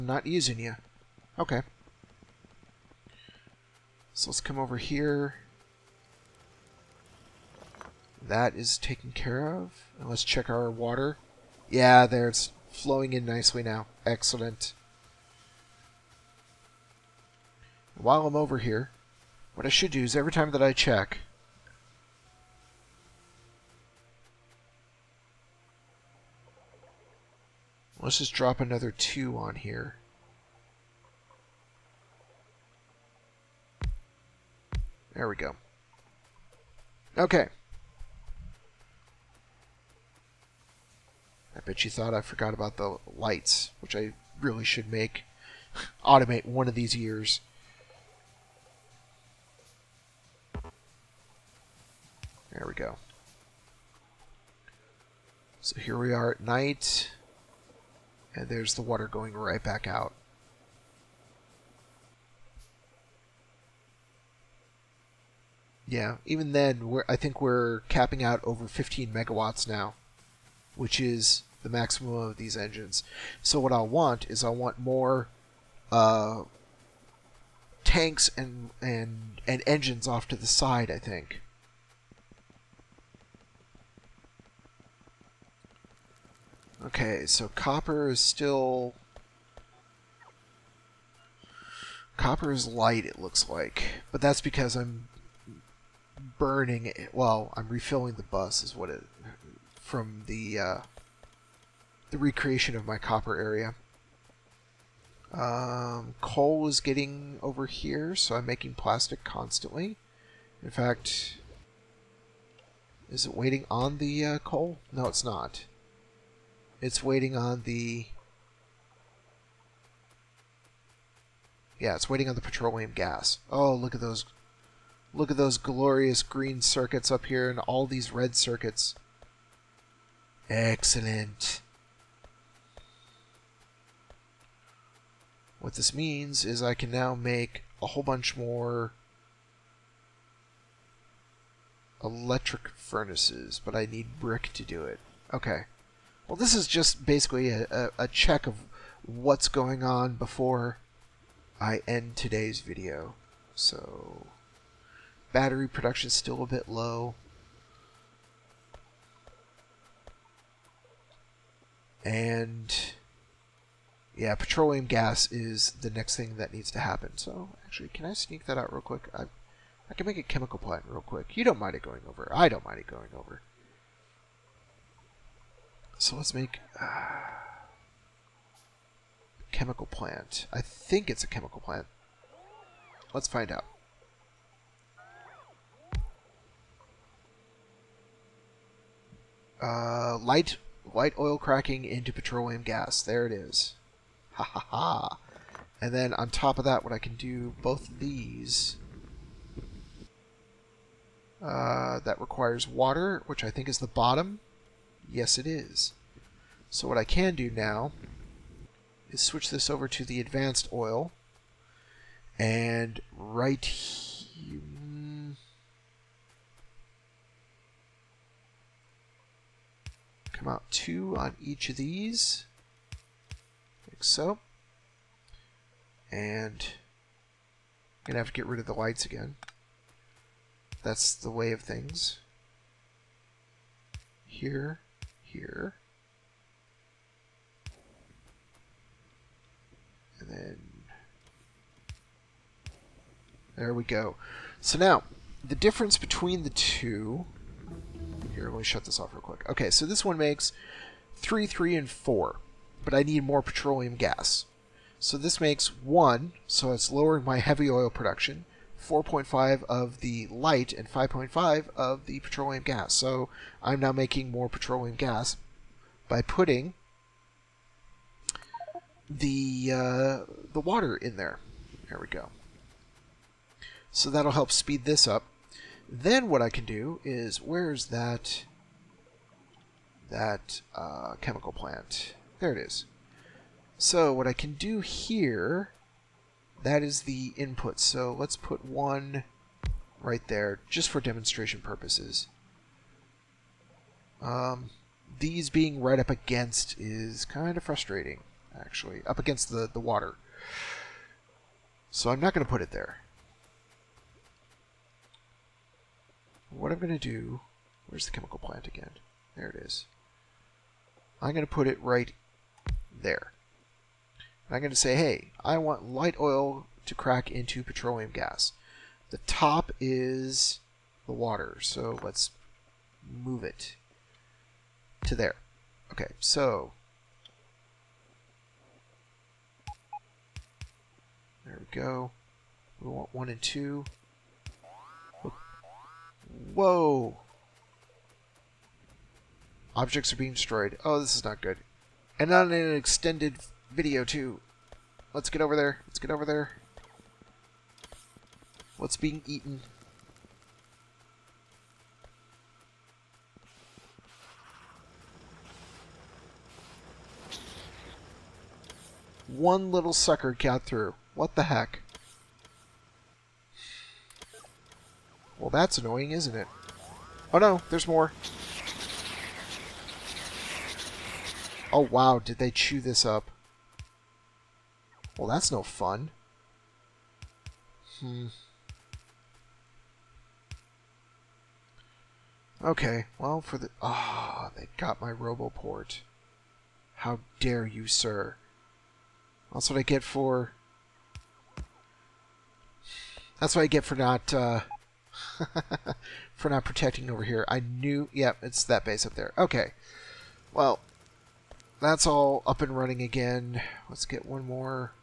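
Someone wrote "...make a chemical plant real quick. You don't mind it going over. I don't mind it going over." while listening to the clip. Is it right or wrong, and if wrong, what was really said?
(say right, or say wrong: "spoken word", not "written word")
right.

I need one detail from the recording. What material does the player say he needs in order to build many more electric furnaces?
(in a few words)
Brick.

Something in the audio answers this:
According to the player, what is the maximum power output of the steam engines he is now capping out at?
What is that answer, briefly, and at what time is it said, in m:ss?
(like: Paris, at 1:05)
15 megawatts, at 1:08.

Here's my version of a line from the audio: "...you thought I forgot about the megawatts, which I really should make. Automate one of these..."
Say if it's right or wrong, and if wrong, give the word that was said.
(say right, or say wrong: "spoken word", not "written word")
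wrong: "lights", not "megawatts".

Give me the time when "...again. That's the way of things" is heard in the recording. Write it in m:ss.
3:49.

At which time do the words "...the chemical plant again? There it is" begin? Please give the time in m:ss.
5:08.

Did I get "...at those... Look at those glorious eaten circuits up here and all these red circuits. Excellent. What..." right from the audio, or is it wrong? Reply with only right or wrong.
wrong.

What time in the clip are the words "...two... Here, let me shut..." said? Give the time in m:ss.
4:06.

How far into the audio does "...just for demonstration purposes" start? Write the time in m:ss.
4:50.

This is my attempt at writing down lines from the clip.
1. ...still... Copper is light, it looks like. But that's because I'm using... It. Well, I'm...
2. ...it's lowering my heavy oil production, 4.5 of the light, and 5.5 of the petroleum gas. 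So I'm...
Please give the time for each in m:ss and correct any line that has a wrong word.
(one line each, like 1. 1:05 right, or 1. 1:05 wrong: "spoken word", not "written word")
1. 1:28 wrong: "burning", not "using"
2. 4:16 right.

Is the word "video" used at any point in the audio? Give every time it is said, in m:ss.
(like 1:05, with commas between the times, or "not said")
2:32, 5:43.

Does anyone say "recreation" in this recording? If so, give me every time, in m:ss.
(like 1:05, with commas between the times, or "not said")
1:42.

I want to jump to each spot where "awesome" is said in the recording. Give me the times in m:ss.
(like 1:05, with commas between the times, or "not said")
not said.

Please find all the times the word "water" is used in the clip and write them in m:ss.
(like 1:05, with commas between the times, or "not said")
0:10, 0:58, 3:22, 4:30, 4:59, 5:21.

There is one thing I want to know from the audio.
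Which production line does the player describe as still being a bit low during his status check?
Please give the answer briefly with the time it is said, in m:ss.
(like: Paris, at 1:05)
Battery production, at 2:35.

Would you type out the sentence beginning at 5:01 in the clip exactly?
So I'm not going to put it there.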